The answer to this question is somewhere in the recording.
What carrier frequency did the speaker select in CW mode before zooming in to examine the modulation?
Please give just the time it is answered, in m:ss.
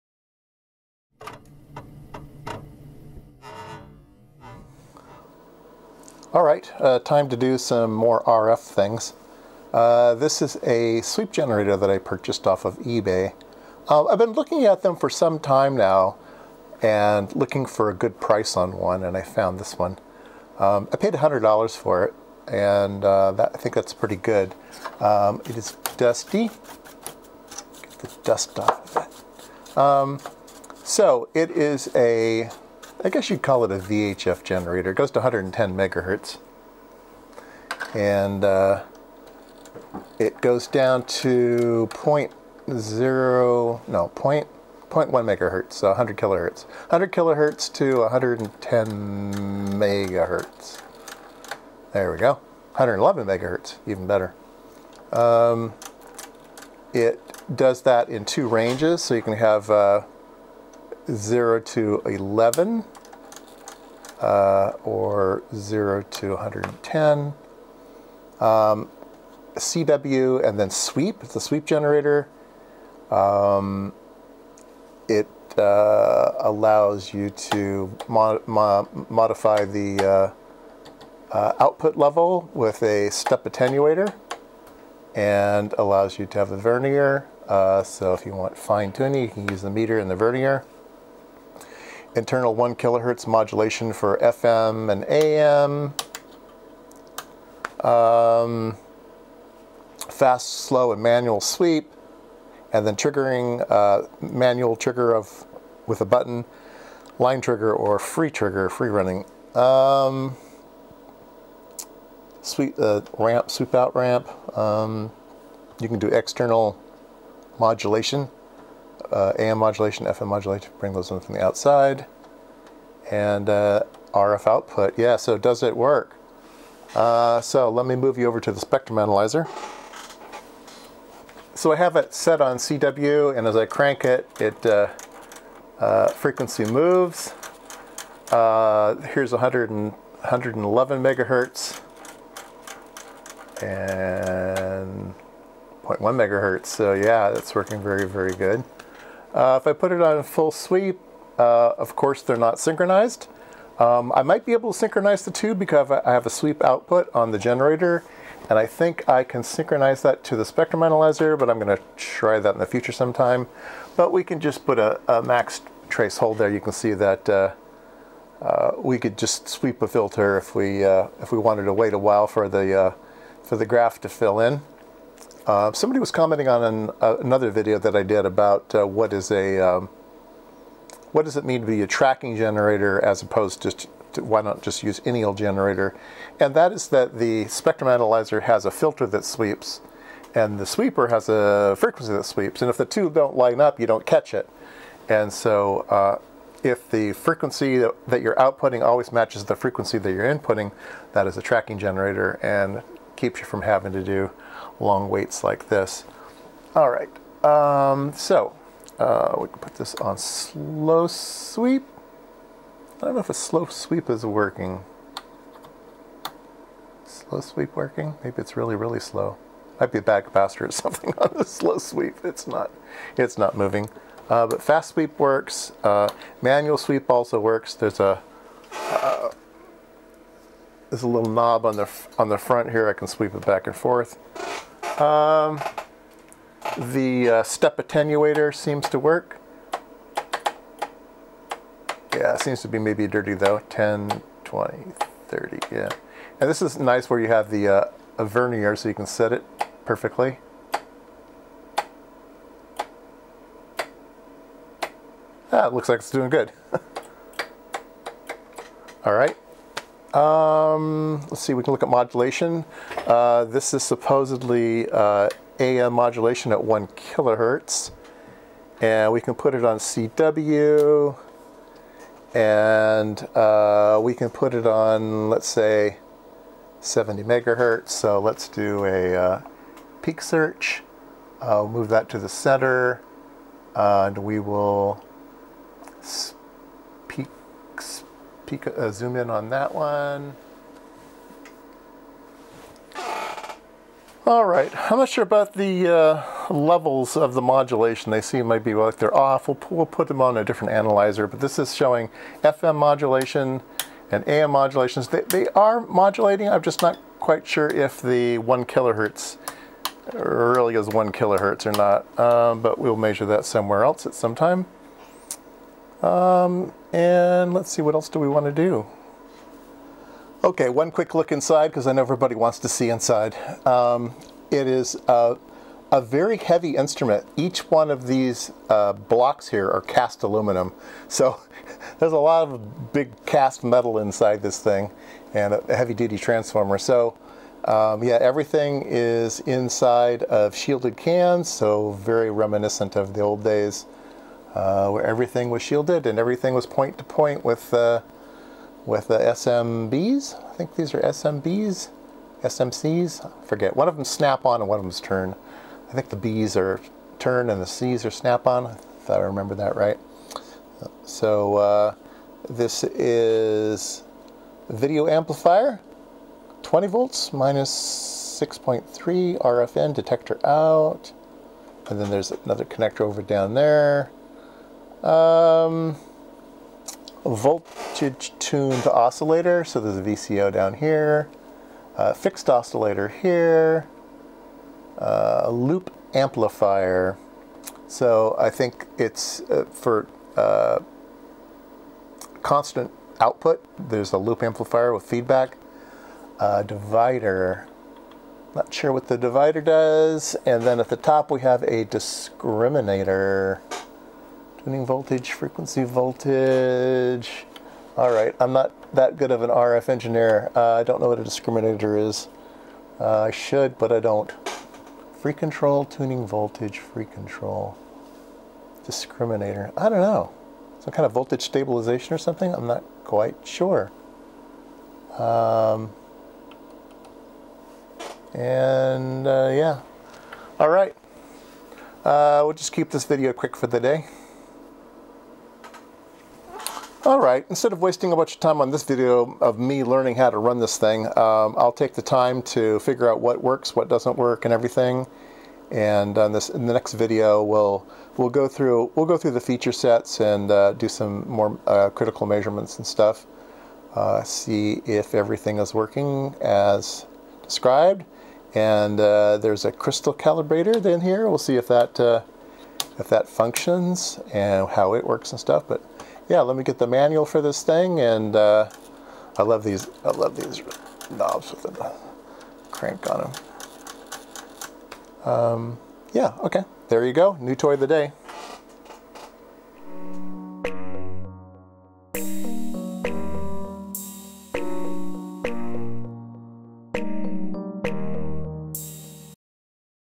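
4:36.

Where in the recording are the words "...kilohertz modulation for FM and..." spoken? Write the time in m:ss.
1:32.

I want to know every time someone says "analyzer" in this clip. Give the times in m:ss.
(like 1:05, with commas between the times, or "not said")
2:08, 2:40, 3:07, 5:00.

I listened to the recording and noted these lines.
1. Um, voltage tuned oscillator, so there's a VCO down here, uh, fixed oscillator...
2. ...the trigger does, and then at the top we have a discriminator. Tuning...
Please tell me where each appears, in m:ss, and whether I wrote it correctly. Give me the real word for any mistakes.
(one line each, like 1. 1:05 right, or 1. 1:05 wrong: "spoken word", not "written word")
1. 6:15 right
2. 6:39 wrong: "divider", not "trigger".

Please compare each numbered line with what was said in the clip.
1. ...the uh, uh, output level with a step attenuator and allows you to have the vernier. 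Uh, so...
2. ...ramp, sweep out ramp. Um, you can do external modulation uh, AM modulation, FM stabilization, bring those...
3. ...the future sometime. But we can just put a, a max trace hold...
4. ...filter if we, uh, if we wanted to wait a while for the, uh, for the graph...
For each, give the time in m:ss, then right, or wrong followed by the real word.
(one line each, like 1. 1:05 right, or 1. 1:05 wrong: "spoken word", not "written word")
1. 1:19 right
2. 1:53 wrong: "modulation", not "stabilization"
3. 2:42 right
4. 2:49 right.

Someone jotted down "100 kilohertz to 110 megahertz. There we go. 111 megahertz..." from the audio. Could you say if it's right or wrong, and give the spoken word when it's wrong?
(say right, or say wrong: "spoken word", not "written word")
right.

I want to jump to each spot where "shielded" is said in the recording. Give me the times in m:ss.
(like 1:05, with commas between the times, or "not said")
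5:40, 5:45.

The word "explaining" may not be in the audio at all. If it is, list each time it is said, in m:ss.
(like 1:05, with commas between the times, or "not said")
not said.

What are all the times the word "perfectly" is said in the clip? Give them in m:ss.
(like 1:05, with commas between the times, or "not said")
4:09.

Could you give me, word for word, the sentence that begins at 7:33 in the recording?
Uh, see if everything is working as described.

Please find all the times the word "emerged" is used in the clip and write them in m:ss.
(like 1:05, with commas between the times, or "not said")
not said.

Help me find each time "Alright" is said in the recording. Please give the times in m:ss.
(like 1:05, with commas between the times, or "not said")
7:17.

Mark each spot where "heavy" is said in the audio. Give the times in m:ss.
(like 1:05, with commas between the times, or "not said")
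5:26, 5:35.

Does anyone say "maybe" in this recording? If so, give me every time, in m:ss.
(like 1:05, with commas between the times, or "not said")
3:38, 4:02, 4:58.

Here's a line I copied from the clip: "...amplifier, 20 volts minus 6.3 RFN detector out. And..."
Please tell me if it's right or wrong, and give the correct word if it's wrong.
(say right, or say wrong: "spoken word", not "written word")
right.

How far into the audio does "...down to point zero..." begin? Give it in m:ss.
0:40.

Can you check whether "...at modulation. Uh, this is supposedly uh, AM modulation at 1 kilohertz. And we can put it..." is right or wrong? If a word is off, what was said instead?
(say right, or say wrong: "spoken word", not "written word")
right.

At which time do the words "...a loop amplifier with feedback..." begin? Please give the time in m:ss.
6:34.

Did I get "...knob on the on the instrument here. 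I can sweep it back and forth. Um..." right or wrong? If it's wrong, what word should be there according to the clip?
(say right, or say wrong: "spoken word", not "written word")
wrong: "front", not "instrument".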